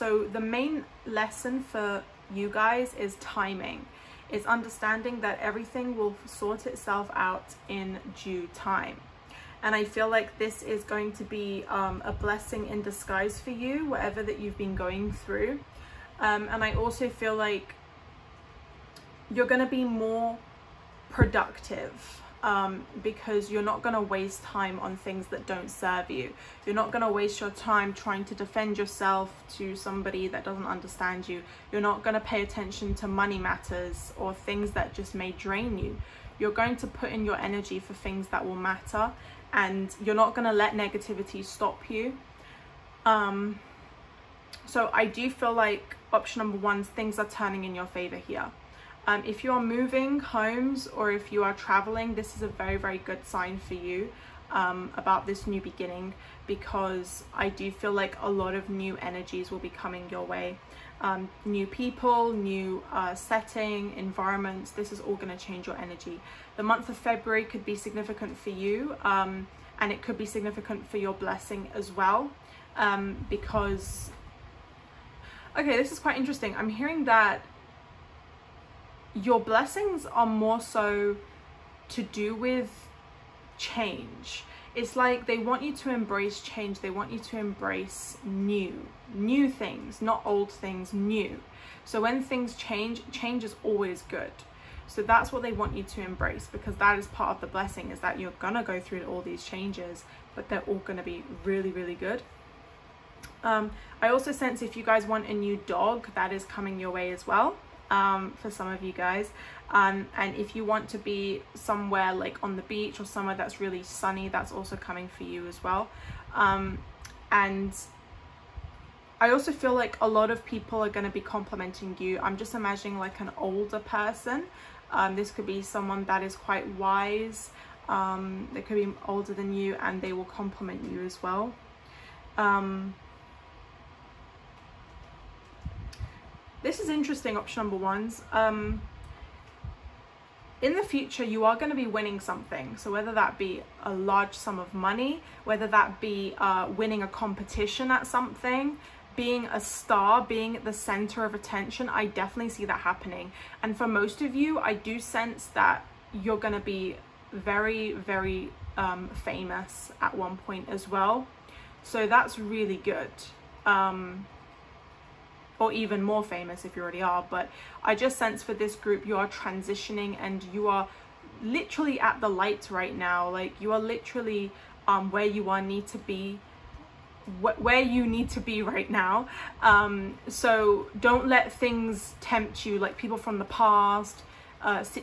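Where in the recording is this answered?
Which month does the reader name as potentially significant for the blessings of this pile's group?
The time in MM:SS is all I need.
01:06.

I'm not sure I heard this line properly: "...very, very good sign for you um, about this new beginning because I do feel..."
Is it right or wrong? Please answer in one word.
right.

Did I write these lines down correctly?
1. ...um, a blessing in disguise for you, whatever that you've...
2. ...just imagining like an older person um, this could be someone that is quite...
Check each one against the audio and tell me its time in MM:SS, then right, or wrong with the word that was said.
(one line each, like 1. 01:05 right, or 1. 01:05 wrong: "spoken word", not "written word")
1. 00:11 right
2. 02:02 right.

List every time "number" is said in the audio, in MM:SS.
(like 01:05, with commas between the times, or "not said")
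00:46, 02:17.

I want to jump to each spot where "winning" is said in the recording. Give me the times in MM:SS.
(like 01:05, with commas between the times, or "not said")
02:21, 02:26.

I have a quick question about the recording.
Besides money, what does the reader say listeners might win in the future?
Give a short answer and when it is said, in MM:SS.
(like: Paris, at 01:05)
a competition, at 02:27.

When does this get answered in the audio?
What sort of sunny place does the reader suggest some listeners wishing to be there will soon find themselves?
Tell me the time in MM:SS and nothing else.
01:52.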